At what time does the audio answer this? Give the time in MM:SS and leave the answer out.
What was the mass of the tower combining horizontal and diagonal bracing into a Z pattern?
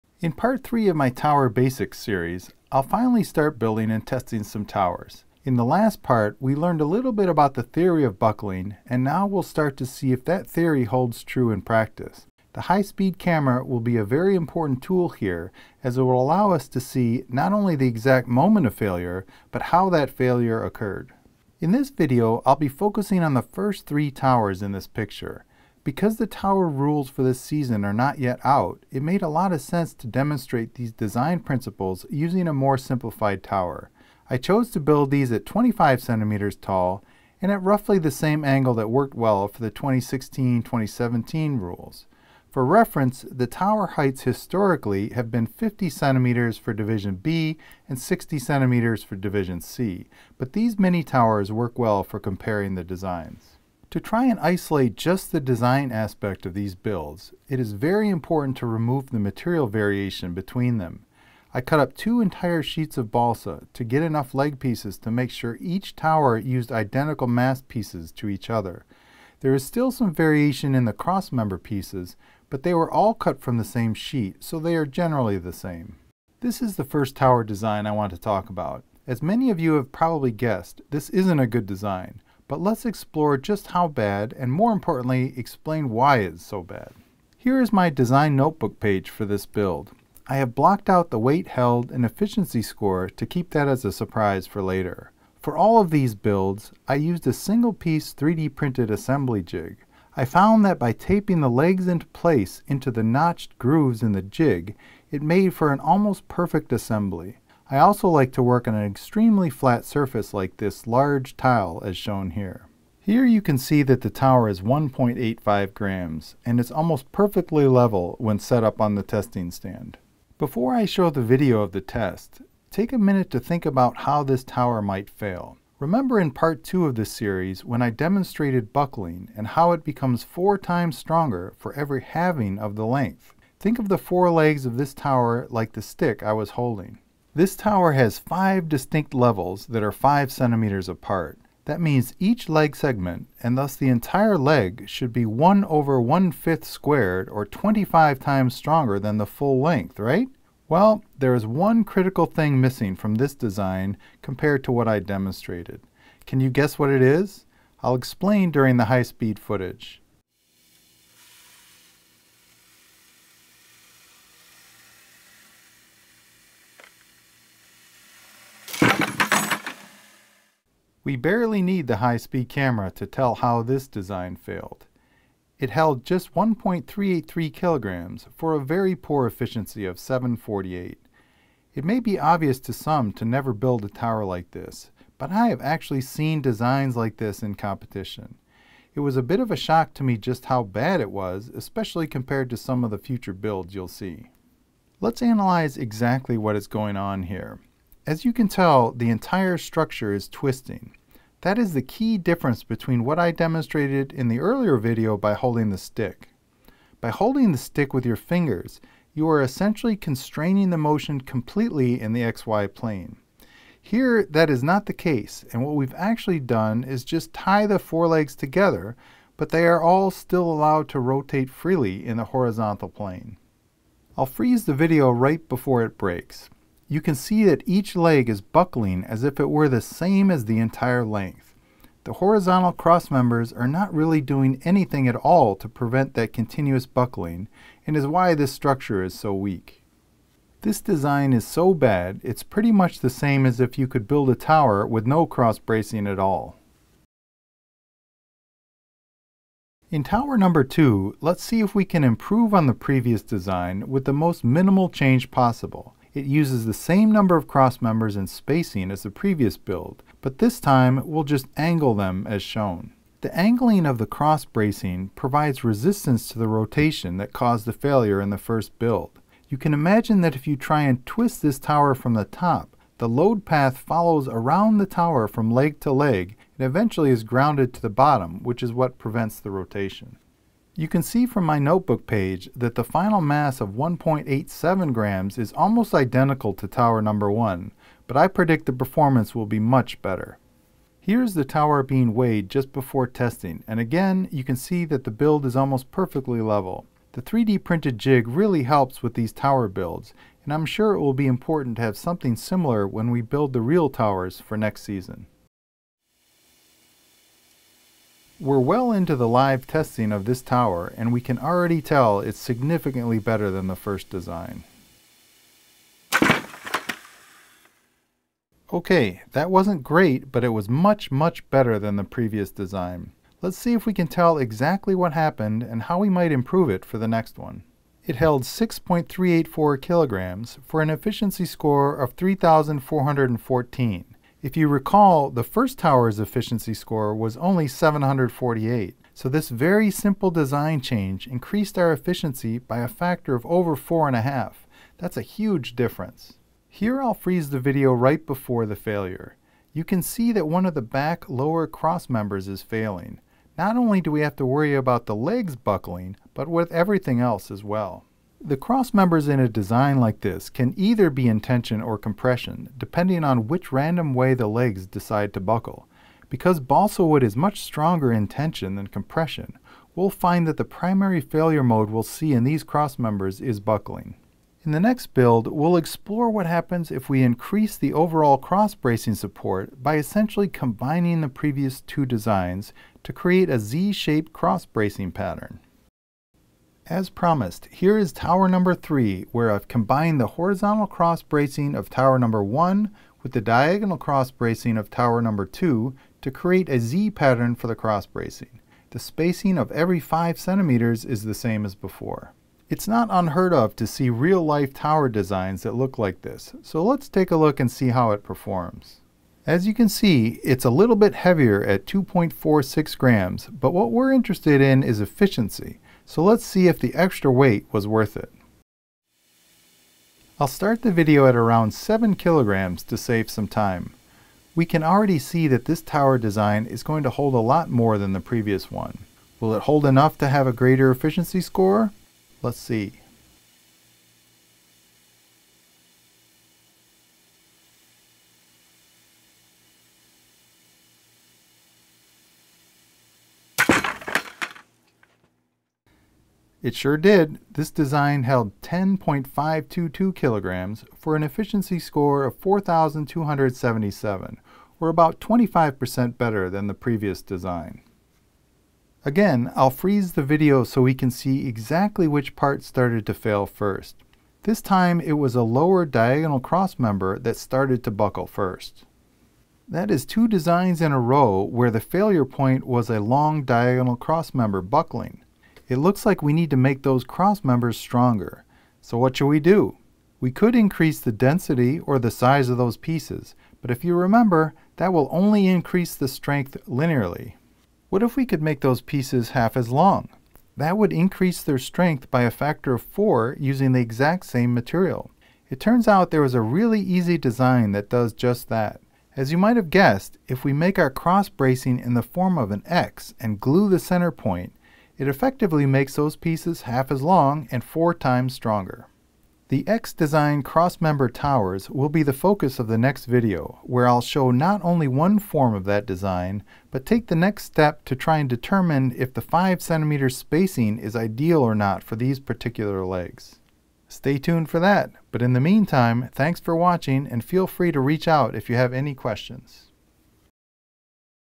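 06:51.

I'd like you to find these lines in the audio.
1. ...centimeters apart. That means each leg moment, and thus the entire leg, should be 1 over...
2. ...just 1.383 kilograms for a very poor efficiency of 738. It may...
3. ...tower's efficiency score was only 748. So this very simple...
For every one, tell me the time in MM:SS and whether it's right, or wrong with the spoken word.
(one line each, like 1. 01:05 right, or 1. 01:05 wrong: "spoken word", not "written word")
1. 02:20 wrong: "segment", not "moment"
2. 02:56 wrong: "748", not "738"
3. 05:35 right.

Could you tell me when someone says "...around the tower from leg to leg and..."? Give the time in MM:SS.
04:34.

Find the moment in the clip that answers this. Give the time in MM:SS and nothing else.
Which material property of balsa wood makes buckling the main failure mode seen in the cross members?
06:07.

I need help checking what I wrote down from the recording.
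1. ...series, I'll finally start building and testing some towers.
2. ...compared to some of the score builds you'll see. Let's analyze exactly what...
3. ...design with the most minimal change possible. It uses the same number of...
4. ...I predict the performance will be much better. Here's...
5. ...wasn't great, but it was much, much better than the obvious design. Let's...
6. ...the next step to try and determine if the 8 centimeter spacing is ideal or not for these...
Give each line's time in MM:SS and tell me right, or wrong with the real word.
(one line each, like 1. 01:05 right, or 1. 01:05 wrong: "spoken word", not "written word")
1. 00:01 right
2. 03:12 wrong: "future", not "score"
3. 04:13 right
4. 04:48 right
5. 05:19 wrong: "previous", not "obvious"
6. 08:37 wrong: "5", not "8".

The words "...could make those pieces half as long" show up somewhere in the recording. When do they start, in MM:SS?
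08:08.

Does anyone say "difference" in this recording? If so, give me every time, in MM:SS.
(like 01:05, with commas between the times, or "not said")
03:22, 05:45.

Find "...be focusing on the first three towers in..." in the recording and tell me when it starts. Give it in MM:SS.
00:22.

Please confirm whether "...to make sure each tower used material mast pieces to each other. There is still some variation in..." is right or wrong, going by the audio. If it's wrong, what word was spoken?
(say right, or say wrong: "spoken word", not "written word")
wrong: "identical", not "material".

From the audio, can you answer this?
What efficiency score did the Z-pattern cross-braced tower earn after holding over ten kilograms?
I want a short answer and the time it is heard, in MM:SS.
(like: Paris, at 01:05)
4,277, at 07:32.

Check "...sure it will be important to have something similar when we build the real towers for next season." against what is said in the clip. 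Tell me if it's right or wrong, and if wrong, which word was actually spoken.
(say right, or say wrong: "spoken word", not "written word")
right.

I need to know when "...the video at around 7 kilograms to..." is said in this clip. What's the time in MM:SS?
07:00.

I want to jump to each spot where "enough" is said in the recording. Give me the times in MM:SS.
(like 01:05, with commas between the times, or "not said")
01:04, 07:09.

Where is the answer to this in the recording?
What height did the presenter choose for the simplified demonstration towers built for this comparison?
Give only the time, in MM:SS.
00:35.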